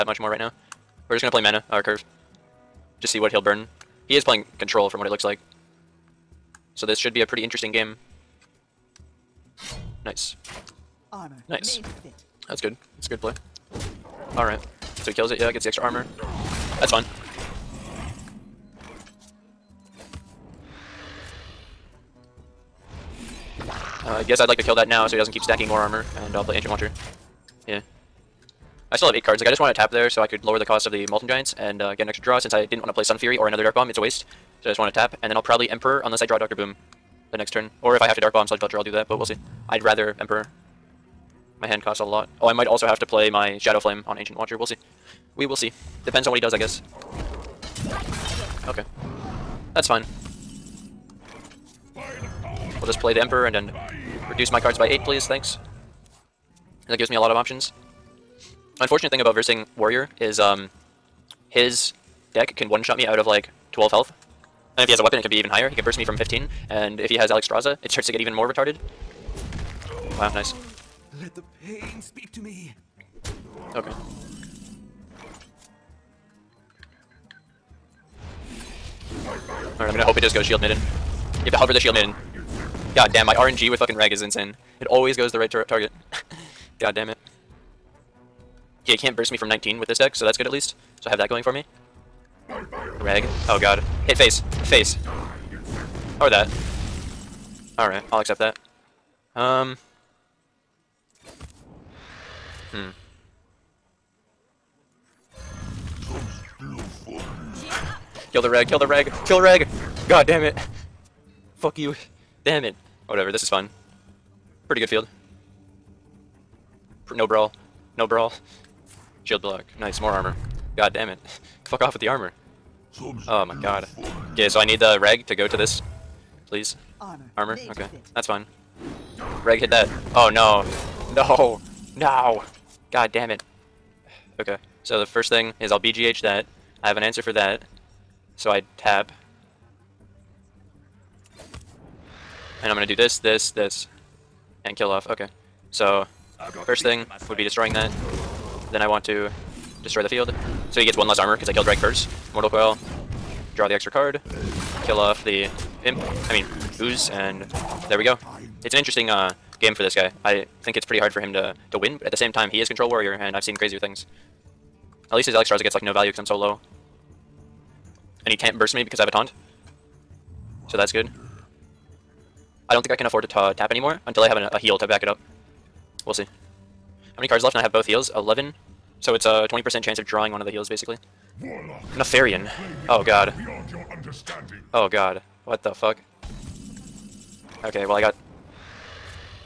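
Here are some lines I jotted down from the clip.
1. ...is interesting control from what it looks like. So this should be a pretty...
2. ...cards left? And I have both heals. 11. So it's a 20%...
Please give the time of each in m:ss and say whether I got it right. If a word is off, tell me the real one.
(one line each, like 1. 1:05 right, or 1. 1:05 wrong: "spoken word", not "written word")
1. 0:04 wrong: "playing", not "interesting"
2. 2:57 right.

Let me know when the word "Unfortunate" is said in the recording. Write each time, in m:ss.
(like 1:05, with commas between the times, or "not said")
0:58.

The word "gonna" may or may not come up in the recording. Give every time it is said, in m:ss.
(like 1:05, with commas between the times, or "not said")
1:19, 2:22.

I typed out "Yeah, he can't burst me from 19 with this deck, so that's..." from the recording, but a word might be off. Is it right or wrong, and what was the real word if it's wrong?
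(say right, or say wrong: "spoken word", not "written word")
right.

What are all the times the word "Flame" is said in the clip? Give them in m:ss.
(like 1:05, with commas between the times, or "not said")
0:43.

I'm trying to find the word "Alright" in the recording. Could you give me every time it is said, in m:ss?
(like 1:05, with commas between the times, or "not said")
0:14, 1:37.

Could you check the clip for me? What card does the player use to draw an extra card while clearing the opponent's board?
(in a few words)
Mortal Coil.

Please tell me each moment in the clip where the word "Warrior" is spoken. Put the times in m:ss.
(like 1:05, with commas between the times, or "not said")
0:59, 2:42.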